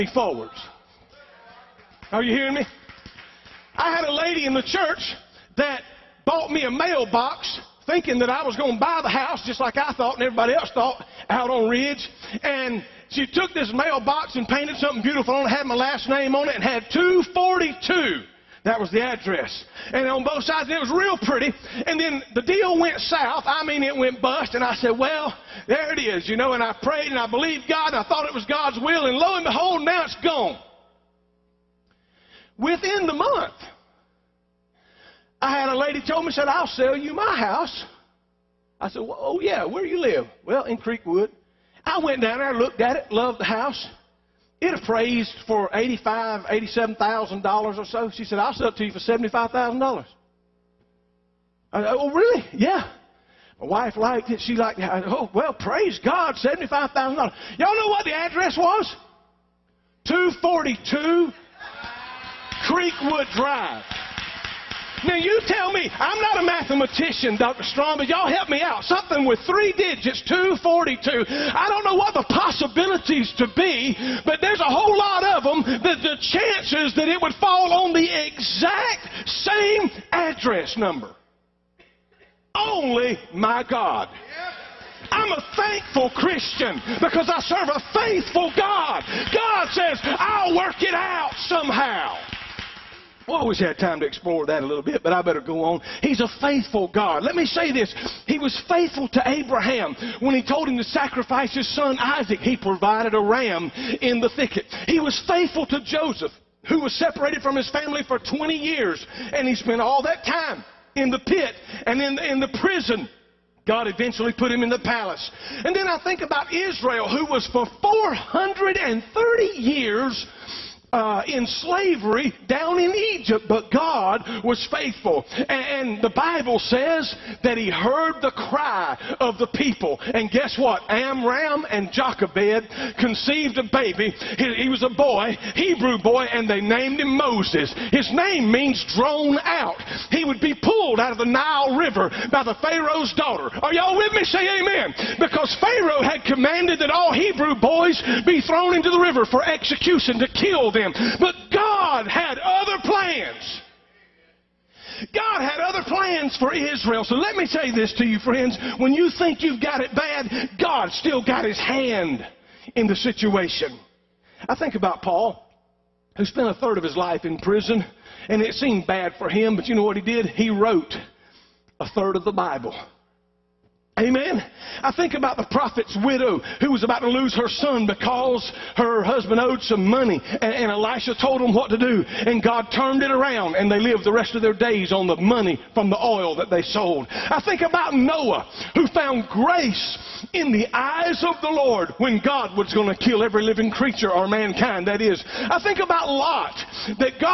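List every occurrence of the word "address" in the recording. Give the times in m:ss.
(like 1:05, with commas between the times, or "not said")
0:19, 0:58, 1:20.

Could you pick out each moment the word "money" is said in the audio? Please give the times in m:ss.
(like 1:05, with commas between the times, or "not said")
2:59, 3:05.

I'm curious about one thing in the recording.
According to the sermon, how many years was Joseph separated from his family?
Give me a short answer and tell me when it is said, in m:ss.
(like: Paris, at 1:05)
20, at 1:48.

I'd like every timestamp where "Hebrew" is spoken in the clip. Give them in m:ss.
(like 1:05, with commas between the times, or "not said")
2:15, 2:27.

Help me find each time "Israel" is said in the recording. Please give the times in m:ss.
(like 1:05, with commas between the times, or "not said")
1:56, 2:36.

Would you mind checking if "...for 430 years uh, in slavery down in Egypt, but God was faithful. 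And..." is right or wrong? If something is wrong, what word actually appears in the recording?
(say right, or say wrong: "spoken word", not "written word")
right.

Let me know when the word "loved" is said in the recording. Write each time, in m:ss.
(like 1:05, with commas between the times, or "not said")
0:43.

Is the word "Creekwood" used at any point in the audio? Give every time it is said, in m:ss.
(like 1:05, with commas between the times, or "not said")
0:40, 1:02.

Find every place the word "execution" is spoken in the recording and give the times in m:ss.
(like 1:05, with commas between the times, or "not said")
2:29.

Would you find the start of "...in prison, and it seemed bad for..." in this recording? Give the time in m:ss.
2:47.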